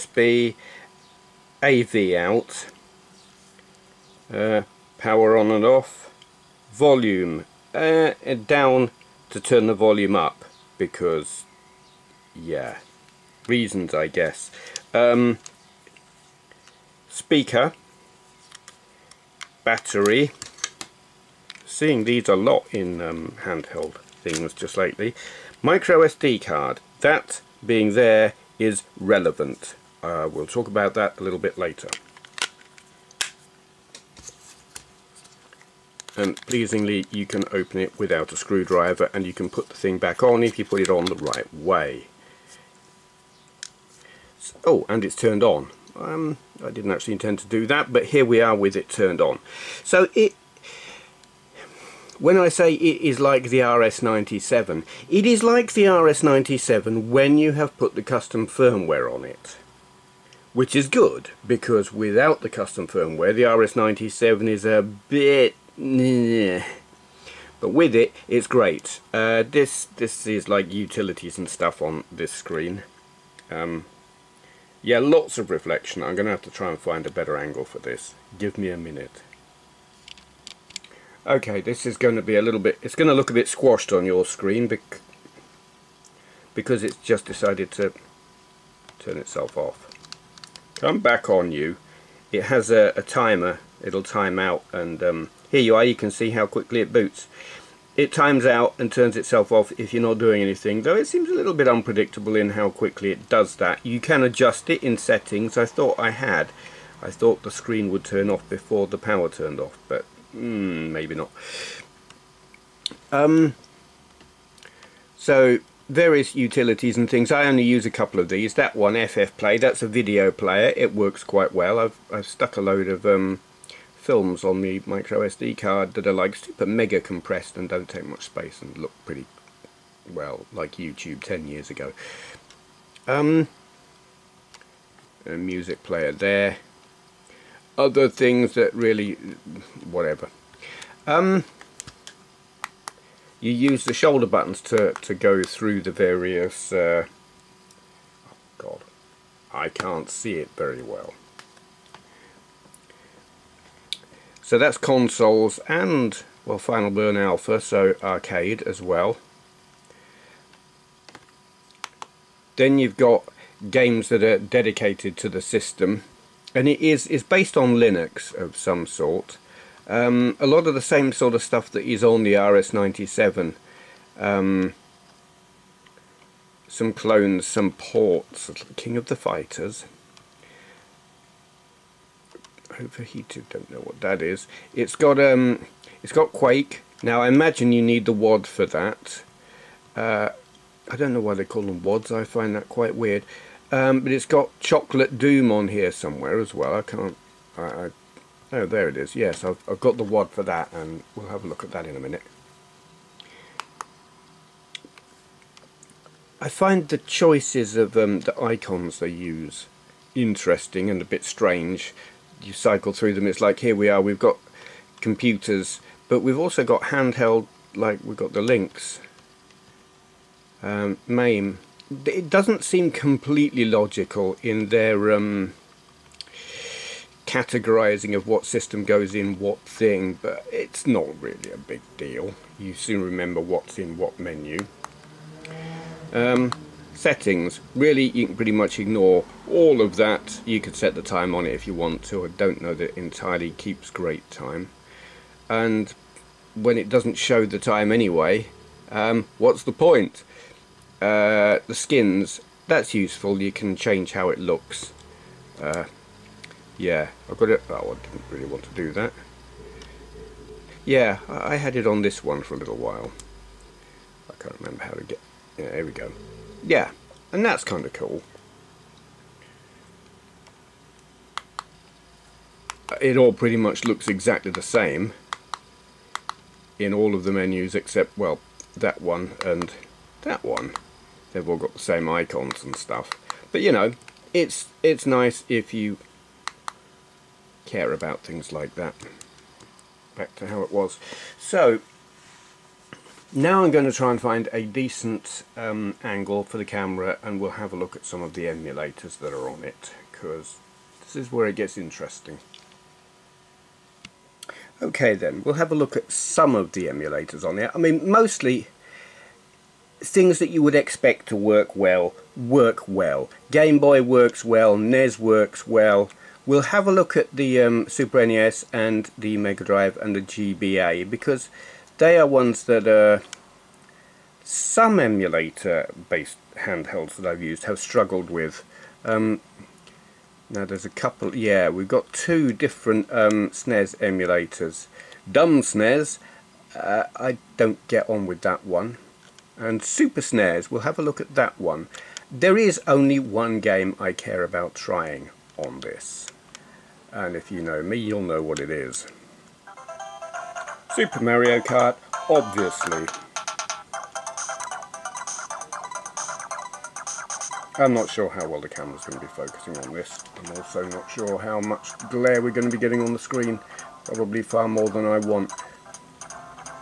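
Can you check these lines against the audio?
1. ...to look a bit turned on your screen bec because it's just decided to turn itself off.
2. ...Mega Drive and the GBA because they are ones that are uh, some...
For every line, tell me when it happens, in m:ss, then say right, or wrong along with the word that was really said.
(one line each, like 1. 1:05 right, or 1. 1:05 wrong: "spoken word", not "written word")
1. 1:23 wrong: "squashed", not "turned"
2. 5:19 right.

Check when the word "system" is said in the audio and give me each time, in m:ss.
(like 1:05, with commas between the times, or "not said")
2:45, 3:48.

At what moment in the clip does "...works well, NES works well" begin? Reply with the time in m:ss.
5:14.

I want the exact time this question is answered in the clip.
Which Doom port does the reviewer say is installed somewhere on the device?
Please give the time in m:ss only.
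3:14.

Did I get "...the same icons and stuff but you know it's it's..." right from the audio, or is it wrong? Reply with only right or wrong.
right.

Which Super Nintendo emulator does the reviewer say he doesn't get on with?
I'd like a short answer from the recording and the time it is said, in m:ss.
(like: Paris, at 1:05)
Dumb SNES, at 5:35.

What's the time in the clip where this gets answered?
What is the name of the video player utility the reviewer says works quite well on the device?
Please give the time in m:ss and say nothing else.
1:59.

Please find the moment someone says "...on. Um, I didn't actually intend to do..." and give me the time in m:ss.
0:45.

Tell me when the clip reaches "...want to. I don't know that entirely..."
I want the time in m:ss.
4:01.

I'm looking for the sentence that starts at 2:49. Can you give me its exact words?
Um, a lot of the same sort of stuff that is on the RS-97.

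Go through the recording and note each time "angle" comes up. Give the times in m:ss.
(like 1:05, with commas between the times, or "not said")
1:17, 4:56.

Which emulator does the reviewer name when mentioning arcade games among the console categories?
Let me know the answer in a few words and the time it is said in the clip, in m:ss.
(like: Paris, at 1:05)
Final Burn Alpha, at 2:36.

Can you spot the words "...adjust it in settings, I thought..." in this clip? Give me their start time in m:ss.
1:44.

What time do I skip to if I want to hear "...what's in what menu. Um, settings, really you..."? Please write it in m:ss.
3:53.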